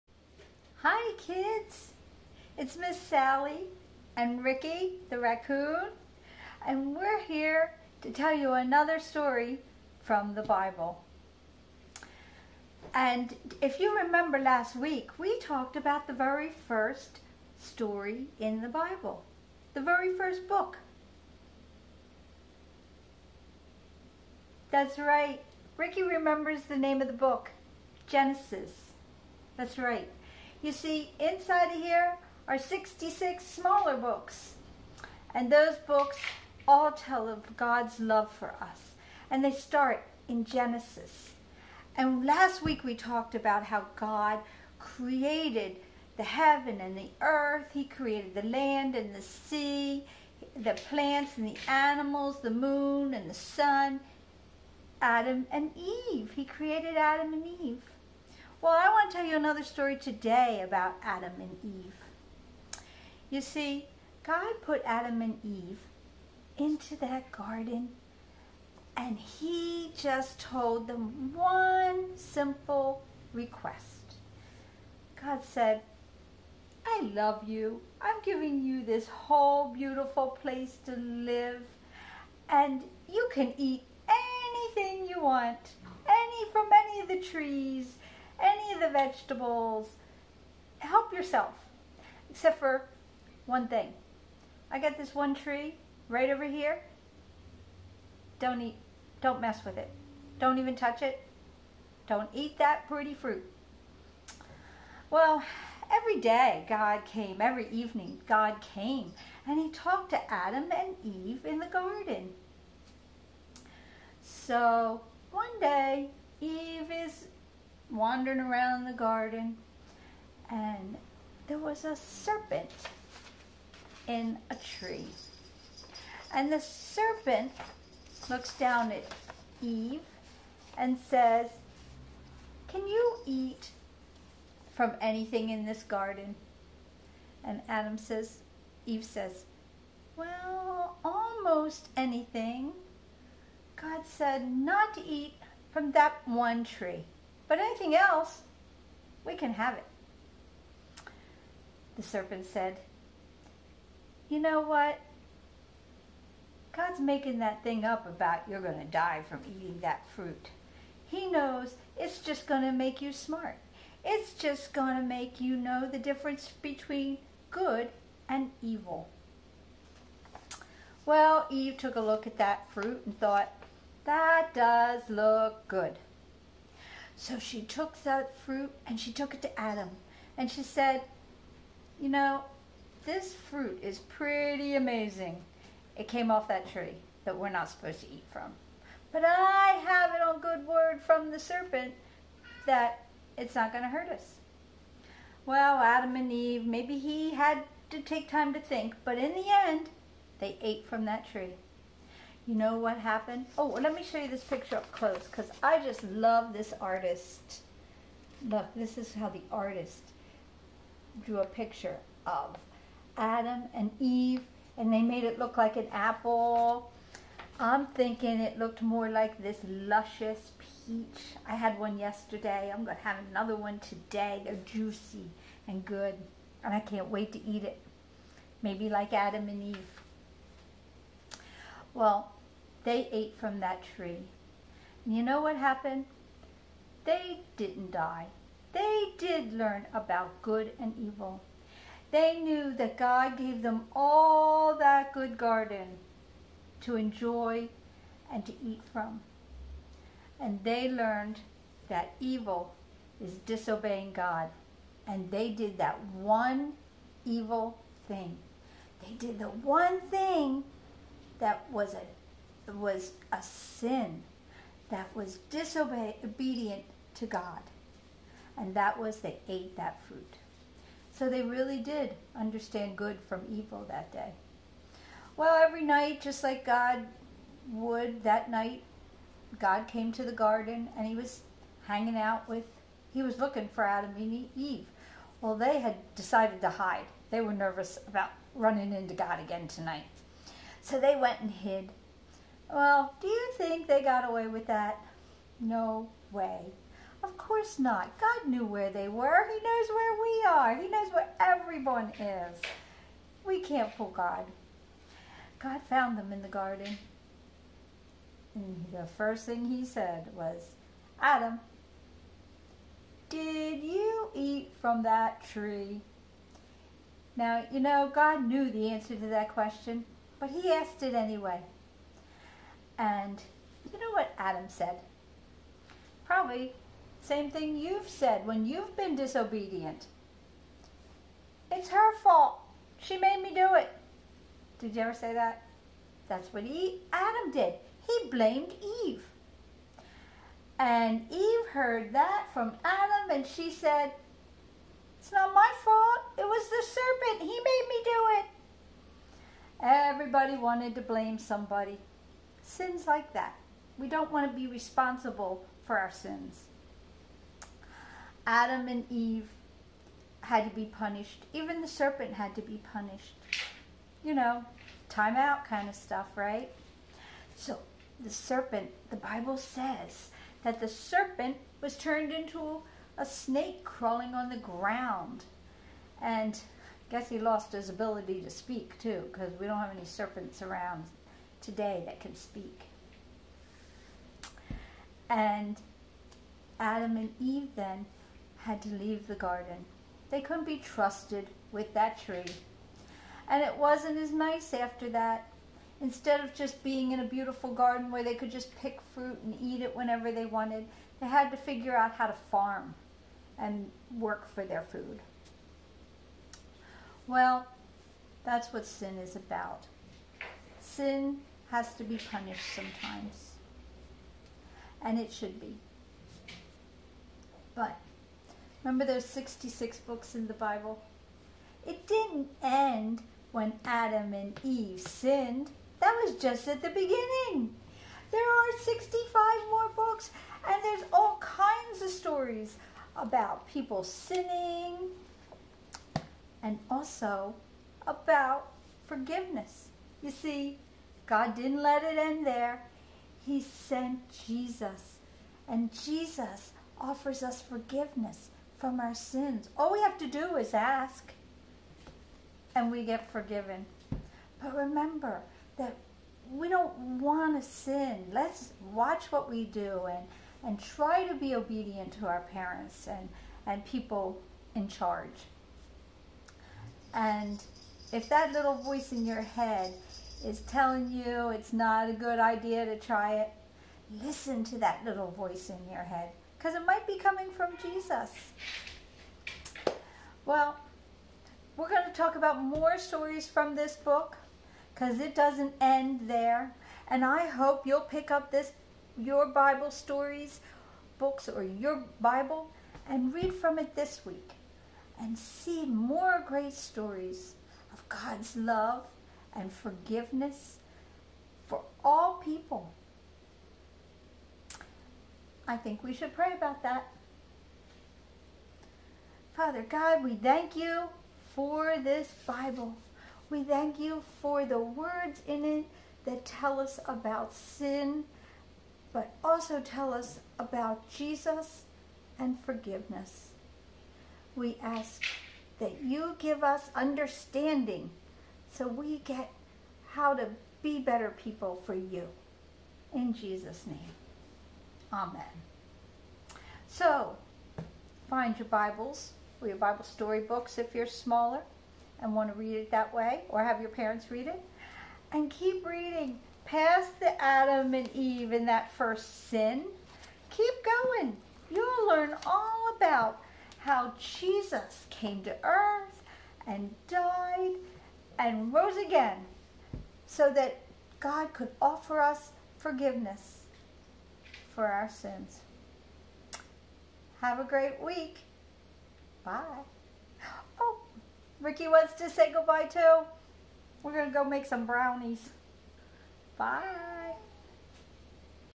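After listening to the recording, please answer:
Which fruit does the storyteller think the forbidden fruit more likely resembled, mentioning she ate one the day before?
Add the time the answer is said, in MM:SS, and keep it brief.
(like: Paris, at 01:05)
Peach, at 03:40.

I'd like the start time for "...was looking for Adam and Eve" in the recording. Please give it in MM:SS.
04:43.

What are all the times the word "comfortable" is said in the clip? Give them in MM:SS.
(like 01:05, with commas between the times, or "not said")
not said.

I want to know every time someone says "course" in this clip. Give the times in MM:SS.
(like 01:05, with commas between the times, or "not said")
04:57.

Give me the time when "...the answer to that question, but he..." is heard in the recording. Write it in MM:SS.
05:18.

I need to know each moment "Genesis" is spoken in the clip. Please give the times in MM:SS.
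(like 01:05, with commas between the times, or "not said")
00:28, 00:40.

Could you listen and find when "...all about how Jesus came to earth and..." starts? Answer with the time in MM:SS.
09:12.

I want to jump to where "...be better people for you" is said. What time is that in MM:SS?
08:50.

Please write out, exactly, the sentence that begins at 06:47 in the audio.
Well, that's what sin is about.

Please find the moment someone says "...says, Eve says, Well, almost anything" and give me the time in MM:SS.
02:17.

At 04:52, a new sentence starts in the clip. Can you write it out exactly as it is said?
Well, do you think they got away with that?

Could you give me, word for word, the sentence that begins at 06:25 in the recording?
And Adam and Eve then had to leave the garden.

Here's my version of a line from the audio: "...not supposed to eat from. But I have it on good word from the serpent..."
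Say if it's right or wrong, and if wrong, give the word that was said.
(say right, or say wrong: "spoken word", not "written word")
right.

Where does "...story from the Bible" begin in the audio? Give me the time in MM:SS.
00:08.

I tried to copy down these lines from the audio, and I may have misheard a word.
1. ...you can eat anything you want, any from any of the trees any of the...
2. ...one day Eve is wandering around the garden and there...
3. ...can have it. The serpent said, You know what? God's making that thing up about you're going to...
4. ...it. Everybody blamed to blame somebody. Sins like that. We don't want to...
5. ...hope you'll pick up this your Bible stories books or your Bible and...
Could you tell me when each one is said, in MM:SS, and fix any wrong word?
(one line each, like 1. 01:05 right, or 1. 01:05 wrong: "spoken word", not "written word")
1. 01:23 right
2. 01:55 right
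3. 02:29 right
4. 05:48 wrong: "wanted", not "blamed"
5. 08:07 right.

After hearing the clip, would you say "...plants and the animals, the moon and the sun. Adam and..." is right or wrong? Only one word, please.
right.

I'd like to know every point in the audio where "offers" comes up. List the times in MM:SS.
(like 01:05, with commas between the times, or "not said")
07:26, 09:21.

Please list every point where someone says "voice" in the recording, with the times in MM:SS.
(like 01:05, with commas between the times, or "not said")
07:48, 07:55.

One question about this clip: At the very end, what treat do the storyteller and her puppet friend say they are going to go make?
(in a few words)
Brownies.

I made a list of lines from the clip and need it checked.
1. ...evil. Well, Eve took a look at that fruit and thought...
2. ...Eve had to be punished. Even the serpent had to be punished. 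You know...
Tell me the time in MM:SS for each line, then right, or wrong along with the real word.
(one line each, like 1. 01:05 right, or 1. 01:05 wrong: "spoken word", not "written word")
1. 02:48 right
2. 05:59 right.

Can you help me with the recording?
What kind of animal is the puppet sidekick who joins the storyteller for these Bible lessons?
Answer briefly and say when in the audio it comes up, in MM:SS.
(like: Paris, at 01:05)
Raccoon, at 00:05.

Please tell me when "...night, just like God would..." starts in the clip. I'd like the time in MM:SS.
04:35.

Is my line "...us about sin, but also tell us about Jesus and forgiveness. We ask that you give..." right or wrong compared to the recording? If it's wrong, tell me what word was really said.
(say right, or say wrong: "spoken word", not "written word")
right.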